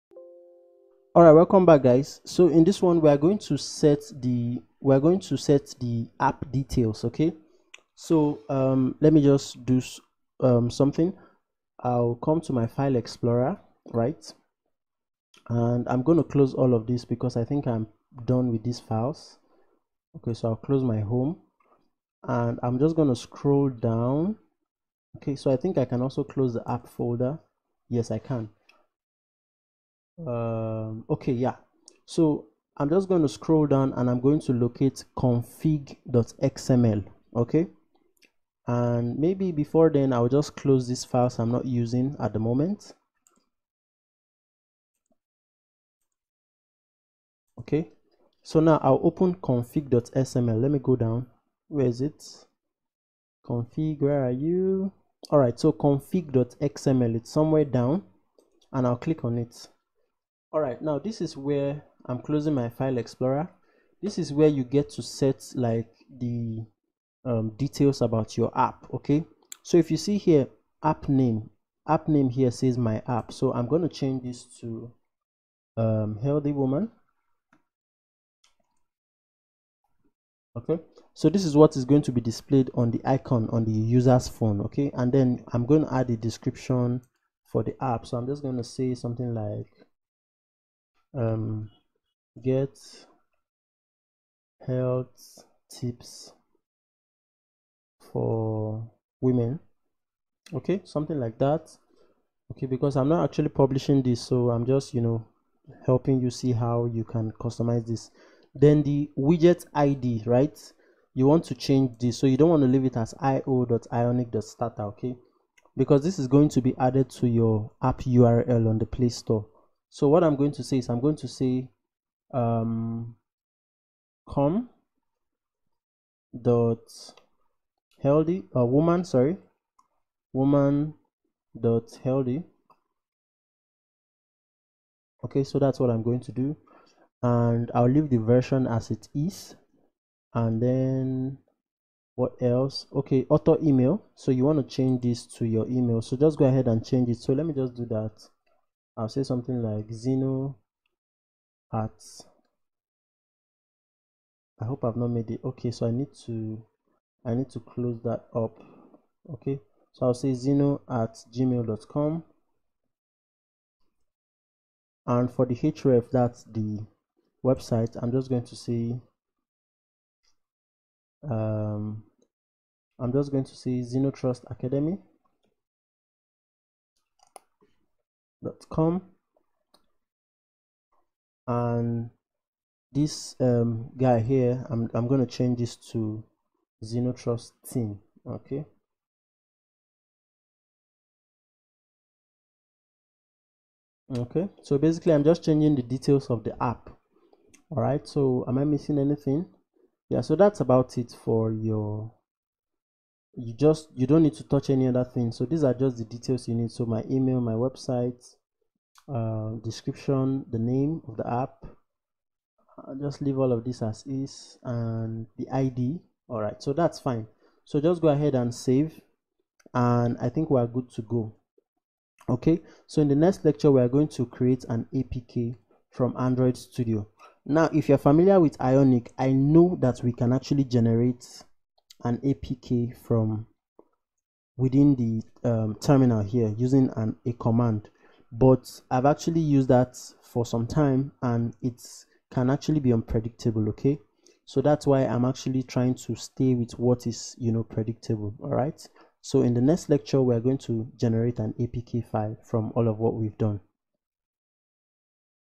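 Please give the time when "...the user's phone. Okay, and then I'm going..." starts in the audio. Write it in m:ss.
1:23.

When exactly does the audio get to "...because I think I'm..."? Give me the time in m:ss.
0:17.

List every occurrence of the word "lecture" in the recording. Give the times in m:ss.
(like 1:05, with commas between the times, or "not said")
3:43, 4:09.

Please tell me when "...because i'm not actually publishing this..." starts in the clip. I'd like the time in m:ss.
1:42.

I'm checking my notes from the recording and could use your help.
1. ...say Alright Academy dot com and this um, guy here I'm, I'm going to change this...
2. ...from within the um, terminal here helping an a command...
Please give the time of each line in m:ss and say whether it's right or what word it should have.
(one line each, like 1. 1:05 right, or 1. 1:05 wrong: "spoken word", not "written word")
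1. 2:53 wrong: "ZinoTrust", not "Alright"
2. 3:53 wrong: "using", not "helping".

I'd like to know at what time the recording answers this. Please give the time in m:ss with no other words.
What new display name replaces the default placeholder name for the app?
1:16.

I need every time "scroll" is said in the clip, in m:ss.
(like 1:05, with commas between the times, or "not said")
0:23, 0:33.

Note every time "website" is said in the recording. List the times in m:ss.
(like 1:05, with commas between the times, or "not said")
2:47, 3:27.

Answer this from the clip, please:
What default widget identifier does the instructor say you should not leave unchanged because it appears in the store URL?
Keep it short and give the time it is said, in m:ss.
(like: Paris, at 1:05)
io.ionic.starter, at 1:53.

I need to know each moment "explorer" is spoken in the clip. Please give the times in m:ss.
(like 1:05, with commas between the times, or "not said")
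0:12, 1:02.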